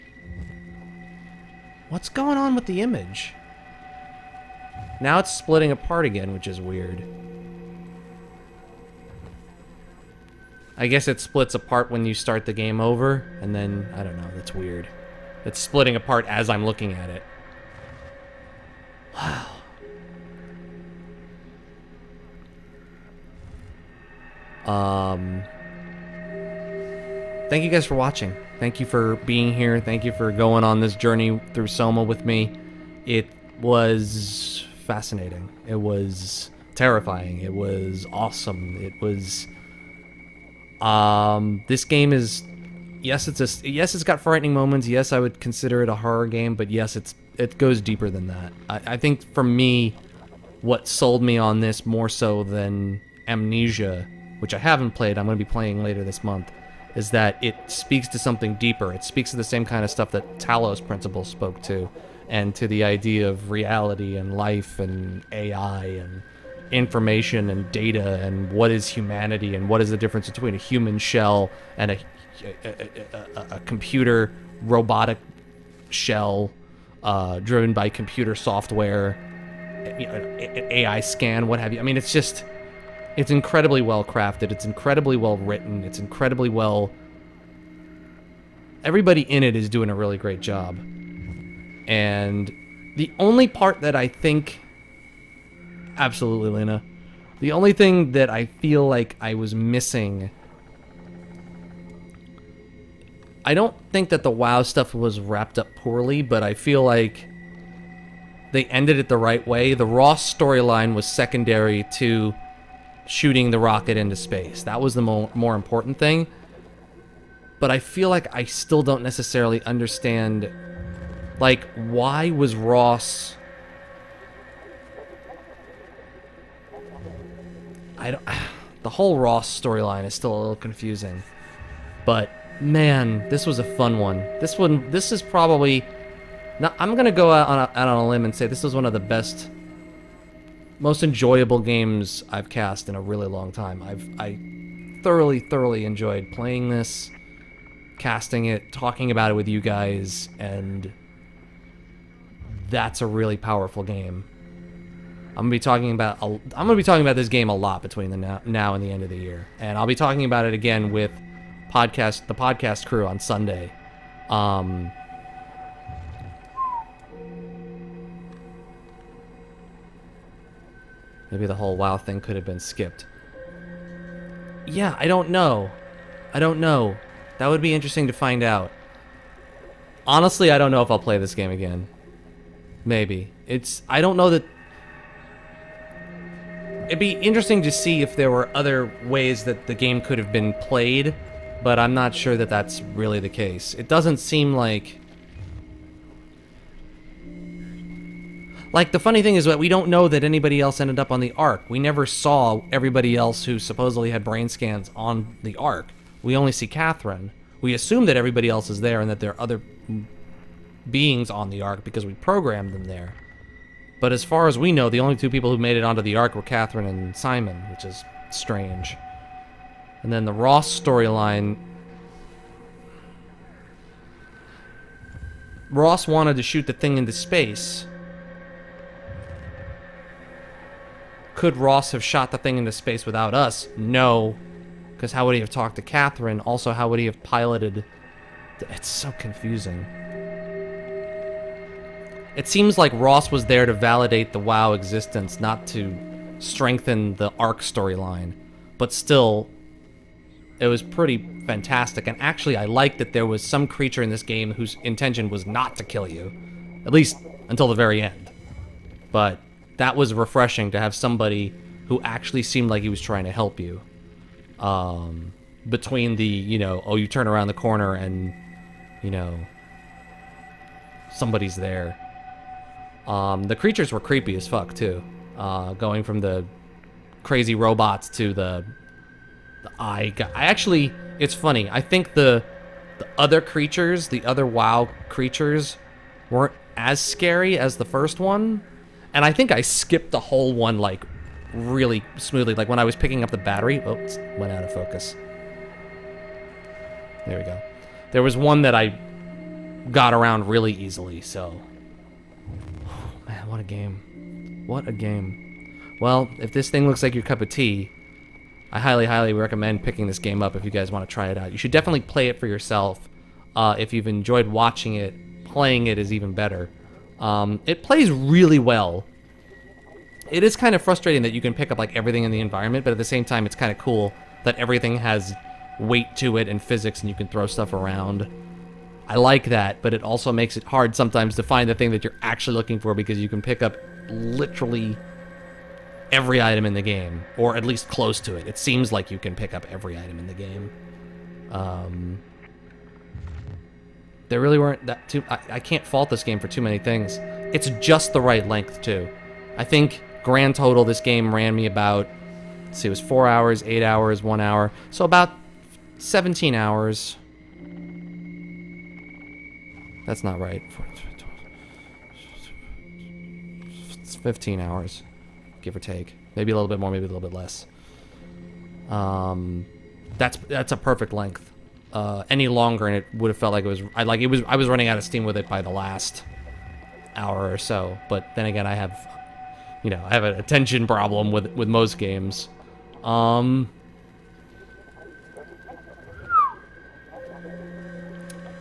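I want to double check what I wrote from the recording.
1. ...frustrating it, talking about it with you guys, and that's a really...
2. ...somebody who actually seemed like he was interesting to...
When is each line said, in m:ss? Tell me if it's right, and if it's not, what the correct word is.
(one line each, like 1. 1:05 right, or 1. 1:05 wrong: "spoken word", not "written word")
1. 2:27 wrong: "casting", not "frustrating"
2. 4:20 wrong: "trying", not "interesting".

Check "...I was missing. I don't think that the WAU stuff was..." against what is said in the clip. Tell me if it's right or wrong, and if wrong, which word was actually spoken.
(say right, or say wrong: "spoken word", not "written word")
right.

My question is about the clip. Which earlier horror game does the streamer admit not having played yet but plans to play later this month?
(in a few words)
Amnesia.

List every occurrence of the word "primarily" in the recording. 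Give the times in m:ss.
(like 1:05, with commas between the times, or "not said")
not said.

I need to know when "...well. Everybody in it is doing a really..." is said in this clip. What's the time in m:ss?
1:26.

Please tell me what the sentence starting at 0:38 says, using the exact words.
It was um, this game is, yes, it's a yes, it's got frightening moments.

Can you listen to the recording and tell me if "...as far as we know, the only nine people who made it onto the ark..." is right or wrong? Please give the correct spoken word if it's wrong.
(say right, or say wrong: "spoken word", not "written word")
wrong: "two", not "nine".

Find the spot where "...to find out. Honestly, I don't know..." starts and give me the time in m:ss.
2:58.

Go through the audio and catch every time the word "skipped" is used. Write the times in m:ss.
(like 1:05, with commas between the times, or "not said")
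2:52, 4:49.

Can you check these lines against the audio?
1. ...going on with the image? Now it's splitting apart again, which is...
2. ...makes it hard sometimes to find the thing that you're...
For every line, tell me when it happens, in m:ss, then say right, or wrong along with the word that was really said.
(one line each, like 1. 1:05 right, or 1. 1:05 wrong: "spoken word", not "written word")
1. 0:02 right
2. 5:30 right.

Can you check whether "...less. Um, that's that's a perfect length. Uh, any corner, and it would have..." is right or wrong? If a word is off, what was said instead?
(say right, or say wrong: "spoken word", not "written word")
wrong: "longer", not "corner".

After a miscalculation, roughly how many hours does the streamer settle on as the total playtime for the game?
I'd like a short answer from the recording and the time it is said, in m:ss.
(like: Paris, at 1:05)
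15 hours, at 6:04.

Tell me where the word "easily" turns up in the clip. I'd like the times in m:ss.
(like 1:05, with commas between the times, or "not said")
5:00.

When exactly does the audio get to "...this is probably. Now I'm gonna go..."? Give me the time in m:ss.
2:14.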